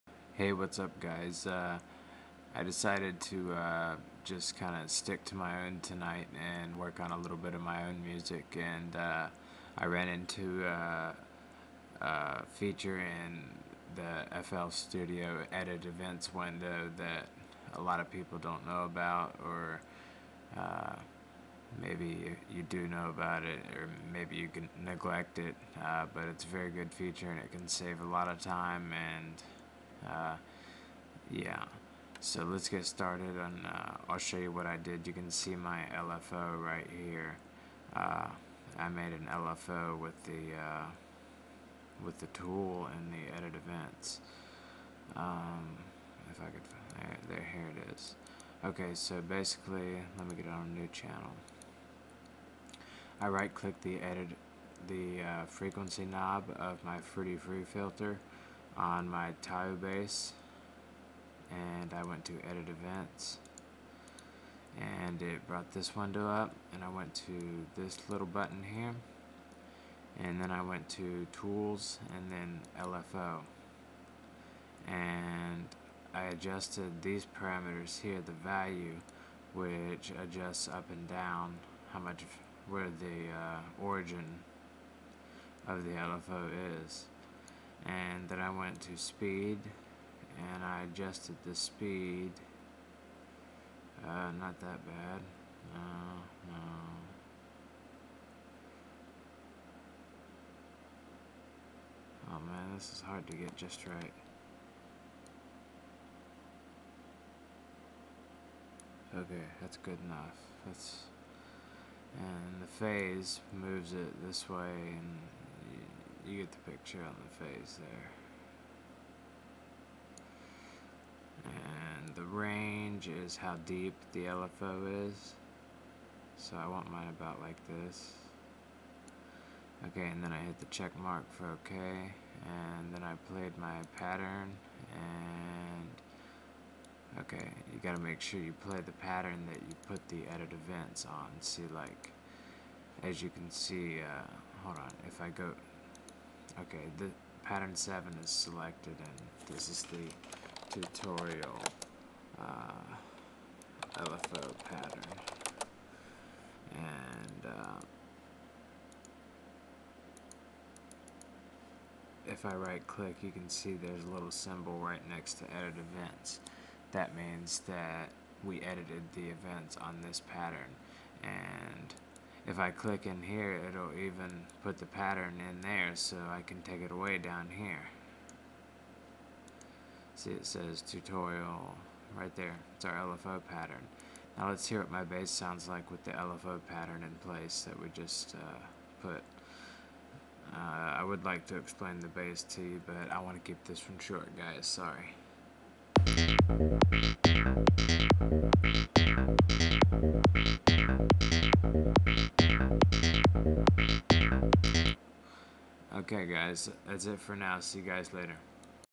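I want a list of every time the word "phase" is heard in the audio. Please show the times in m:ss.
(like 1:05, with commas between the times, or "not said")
1:52, 1:57.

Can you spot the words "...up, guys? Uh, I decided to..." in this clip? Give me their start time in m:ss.
0:00.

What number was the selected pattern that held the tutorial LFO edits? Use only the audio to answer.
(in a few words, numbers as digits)
7.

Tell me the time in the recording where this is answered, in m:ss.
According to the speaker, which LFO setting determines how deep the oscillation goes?
2:02.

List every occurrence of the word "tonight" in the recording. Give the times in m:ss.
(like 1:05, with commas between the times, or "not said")
0:05.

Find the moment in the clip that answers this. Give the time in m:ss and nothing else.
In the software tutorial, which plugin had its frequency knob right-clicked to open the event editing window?
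0:56.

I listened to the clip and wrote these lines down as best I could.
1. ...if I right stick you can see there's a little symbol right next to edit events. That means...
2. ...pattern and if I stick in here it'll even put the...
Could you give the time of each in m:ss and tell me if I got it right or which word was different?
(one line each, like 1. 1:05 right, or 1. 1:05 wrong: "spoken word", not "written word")
1. 2:42 wrong: "click", not "stick"
2. 2:50 wrong: "click", not "stick".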